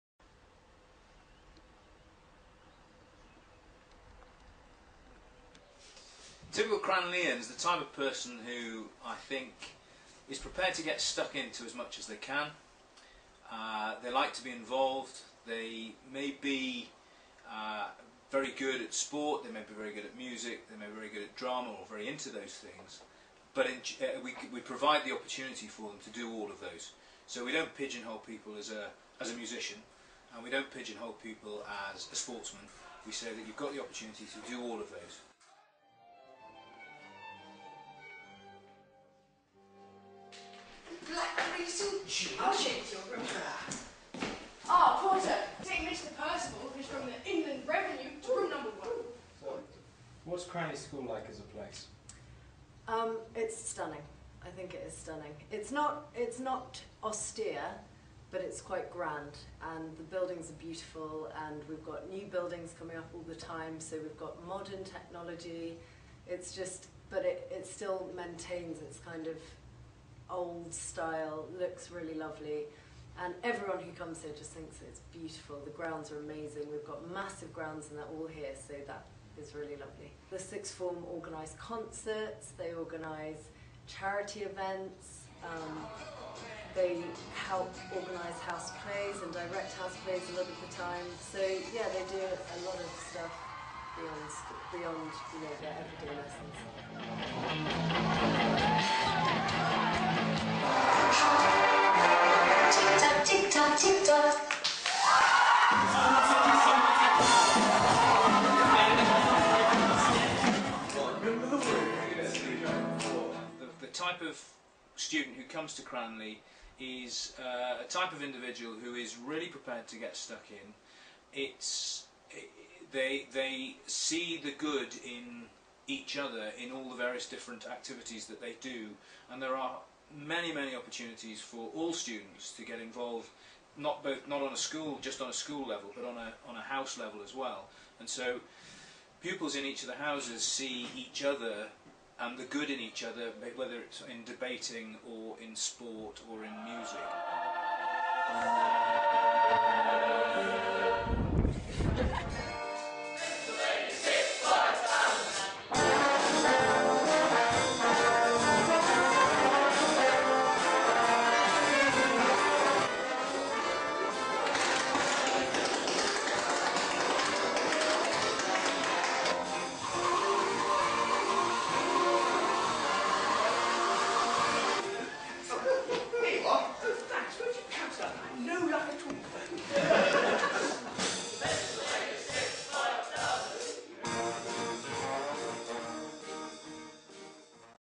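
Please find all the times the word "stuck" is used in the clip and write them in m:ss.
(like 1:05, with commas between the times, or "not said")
0:10, 2:00.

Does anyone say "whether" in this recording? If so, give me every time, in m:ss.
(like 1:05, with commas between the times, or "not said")
2:23.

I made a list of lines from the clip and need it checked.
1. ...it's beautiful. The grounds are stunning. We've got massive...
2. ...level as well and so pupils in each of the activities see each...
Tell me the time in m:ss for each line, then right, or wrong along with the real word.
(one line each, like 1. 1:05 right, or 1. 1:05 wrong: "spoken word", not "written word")
1. 1:14 wrong: "amazing", not "stunning"
2. 2:16 wrong: "houses", not "activities".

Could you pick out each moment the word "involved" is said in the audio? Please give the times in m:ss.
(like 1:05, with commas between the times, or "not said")
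0:14, 2:12.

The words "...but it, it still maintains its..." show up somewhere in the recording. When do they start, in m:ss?
1:07.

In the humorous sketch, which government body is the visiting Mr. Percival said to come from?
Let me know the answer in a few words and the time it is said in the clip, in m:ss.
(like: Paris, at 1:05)
Inland Revenue, at 0:47.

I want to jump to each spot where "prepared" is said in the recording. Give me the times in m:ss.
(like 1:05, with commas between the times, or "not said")
0:10, 1:59.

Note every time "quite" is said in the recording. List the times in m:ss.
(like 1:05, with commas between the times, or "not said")
0:58.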